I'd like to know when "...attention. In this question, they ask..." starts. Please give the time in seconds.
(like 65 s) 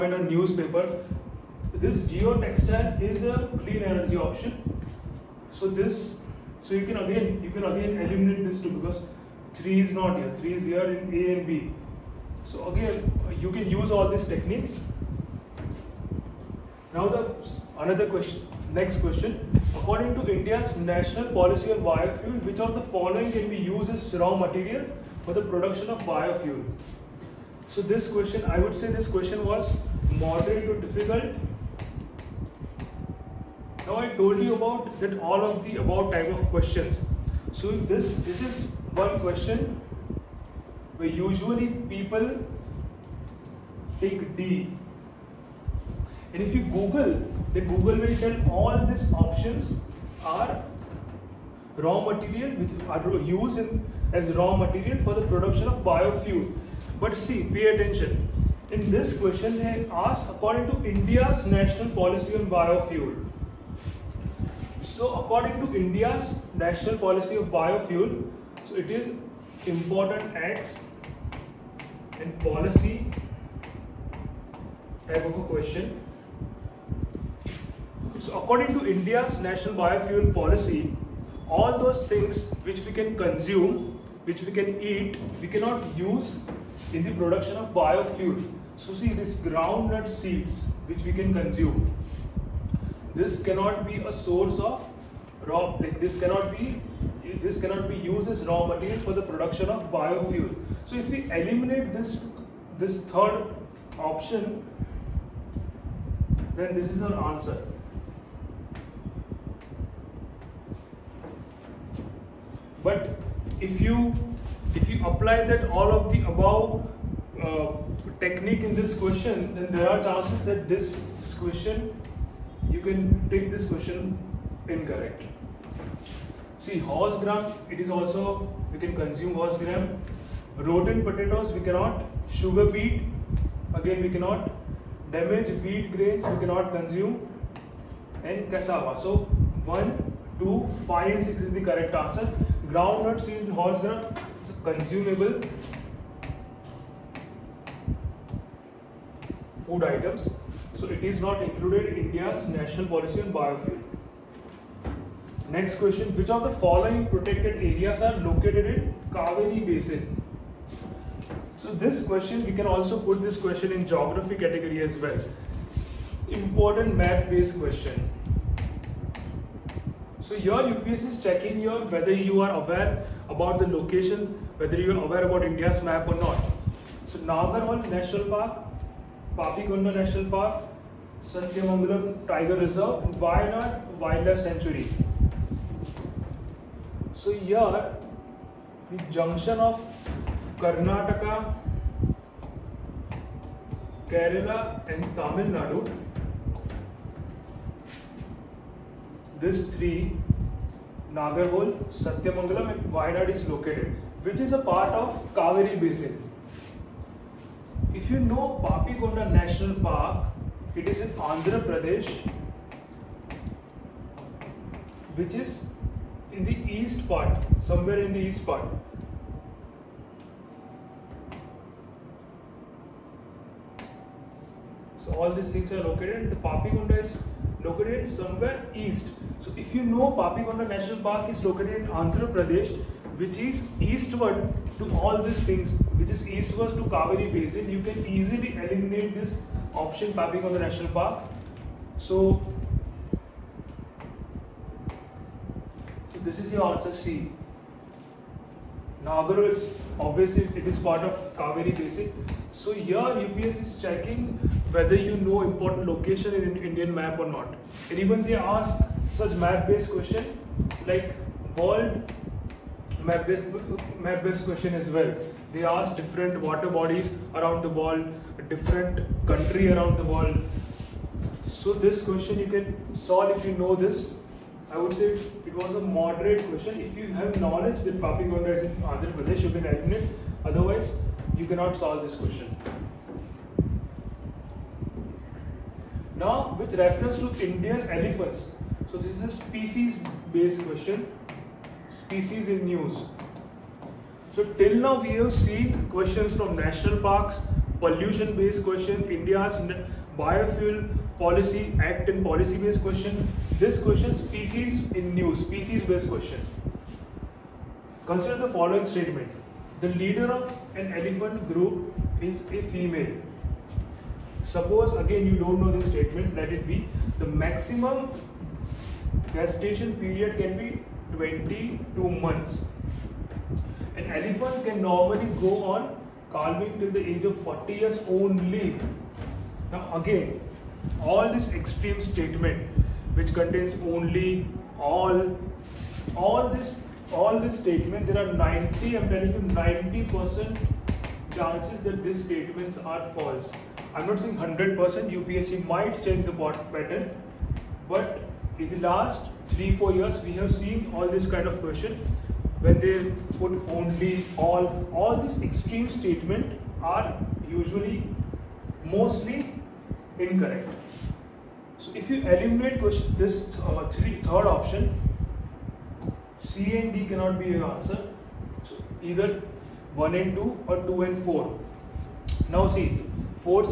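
57 s.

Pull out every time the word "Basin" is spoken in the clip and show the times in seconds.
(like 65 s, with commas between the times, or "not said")
159 s, 237 s, 251 s.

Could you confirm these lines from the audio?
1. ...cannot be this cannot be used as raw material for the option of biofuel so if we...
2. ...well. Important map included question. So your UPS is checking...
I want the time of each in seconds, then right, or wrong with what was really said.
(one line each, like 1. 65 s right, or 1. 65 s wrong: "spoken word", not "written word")
1. 96 s wrong: "production", not "option"
2. 164 s wrong: "based", not "included".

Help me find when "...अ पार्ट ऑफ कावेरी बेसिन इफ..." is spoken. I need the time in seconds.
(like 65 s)
204 s.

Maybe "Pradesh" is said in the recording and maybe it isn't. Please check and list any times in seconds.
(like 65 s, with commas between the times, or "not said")
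211 s, 232 s, 279 s.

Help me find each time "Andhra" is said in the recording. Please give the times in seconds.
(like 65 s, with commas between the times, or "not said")
211 s, 231 s, 278 s.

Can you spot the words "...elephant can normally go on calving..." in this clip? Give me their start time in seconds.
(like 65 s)
324 s.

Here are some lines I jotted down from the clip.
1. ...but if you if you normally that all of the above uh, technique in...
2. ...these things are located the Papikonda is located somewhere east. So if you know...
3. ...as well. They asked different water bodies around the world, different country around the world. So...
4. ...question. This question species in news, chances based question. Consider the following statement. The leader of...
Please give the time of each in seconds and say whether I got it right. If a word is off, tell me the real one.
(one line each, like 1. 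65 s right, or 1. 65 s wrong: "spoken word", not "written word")
1. 112 s wrong: "apply", not "normally"
2. 225 s right
3. 264 s right
4. 302 s wrong: "species", not "chances".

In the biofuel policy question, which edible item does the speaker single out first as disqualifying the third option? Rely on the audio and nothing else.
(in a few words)
Groundnut seeds.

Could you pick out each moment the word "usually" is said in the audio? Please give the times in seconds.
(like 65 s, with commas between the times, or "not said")
41 s, 357 s.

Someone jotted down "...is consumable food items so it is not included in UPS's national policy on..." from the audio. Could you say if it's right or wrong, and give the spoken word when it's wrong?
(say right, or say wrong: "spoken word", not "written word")
wrong: "India", not "UPS".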